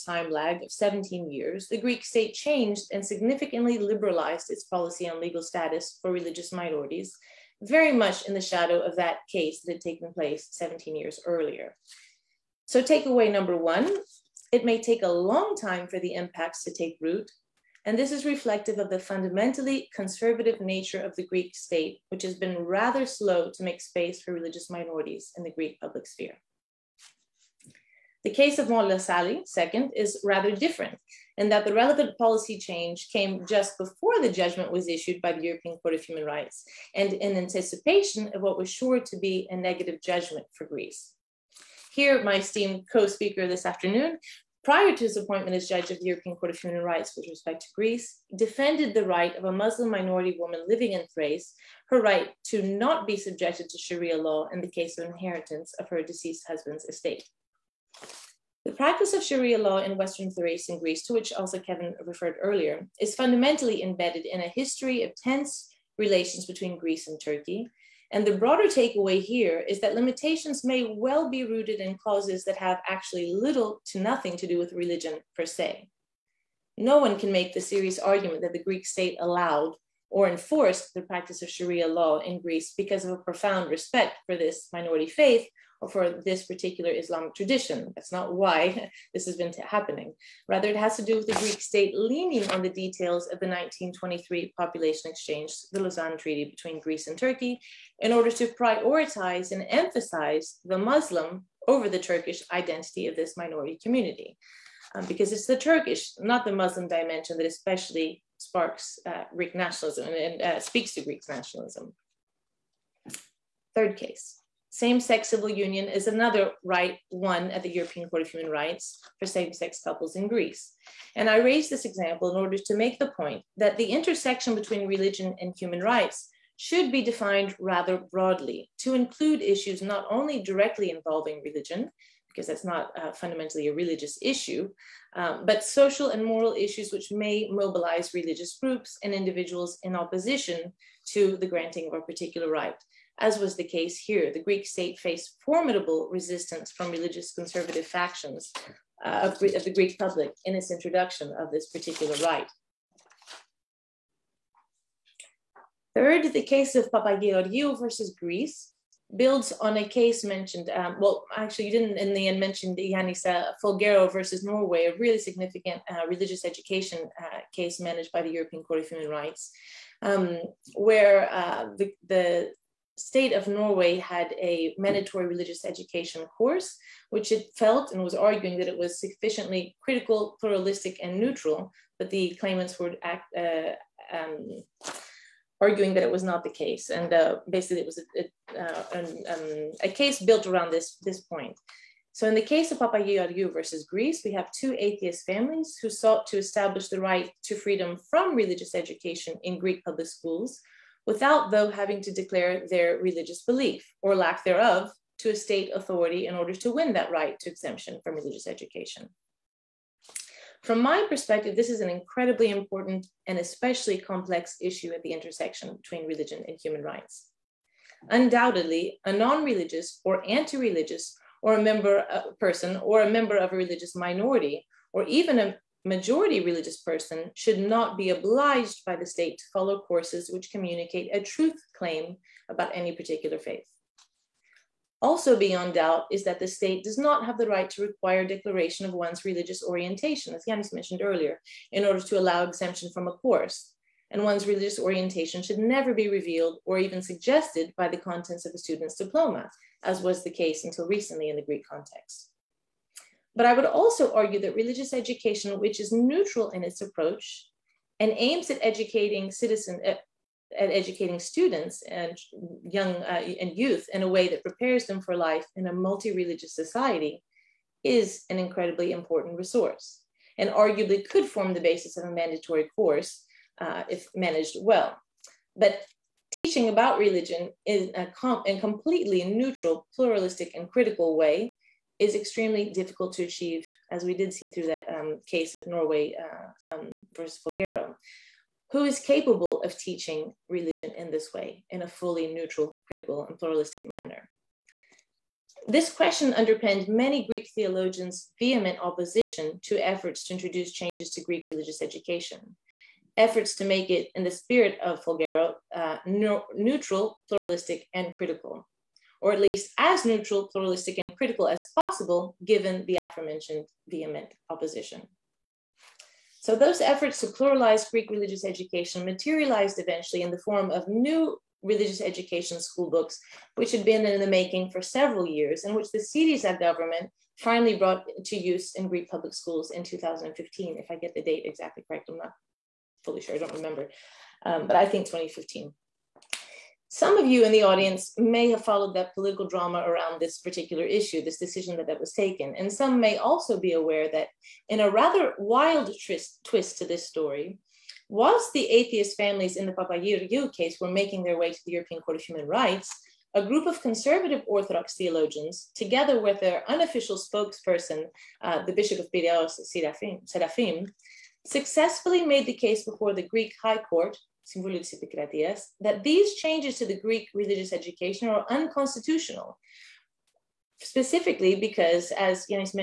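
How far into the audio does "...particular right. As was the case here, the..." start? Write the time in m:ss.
2:22.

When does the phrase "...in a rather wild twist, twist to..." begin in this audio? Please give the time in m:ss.
5:44.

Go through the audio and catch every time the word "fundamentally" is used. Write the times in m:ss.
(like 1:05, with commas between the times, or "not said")
0:18, 1:03, 2:13.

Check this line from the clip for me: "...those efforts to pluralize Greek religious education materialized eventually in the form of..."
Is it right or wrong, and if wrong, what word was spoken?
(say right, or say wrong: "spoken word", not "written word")
right.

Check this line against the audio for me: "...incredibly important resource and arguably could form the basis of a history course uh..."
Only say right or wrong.
wrong.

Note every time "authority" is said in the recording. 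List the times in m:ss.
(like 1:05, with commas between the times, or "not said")
3:25.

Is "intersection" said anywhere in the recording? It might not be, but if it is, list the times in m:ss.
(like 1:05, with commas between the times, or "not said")
2:03, 3:35.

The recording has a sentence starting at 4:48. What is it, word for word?
Who is capable of teaching religion in this way, in a fully neutral, critical, and pluralistic manner?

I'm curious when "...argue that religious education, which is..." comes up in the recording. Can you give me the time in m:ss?
4:14.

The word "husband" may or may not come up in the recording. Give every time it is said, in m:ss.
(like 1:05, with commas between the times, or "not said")
0:56.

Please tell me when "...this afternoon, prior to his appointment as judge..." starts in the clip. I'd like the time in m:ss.
0:43.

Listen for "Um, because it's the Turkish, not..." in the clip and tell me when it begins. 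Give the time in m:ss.
1:44.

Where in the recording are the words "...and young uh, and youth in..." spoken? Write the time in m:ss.
4:21.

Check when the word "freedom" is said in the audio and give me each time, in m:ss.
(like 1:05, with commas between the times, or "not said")
3:17.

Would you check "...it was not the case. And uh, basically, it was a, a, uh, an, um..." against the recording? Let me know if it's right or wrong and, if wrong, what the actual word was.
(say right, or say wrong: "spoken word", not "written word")
right.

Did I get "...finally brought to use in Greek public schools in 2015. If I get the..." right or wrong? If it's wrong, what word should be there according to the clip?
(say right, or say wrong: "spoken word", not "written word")
right.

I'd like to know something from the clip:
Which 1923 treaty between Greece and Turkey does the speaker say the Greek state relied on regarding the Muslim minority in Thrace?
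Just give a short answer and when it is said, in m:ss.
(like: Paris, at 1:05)
Lausanne Treaty, at 1:35.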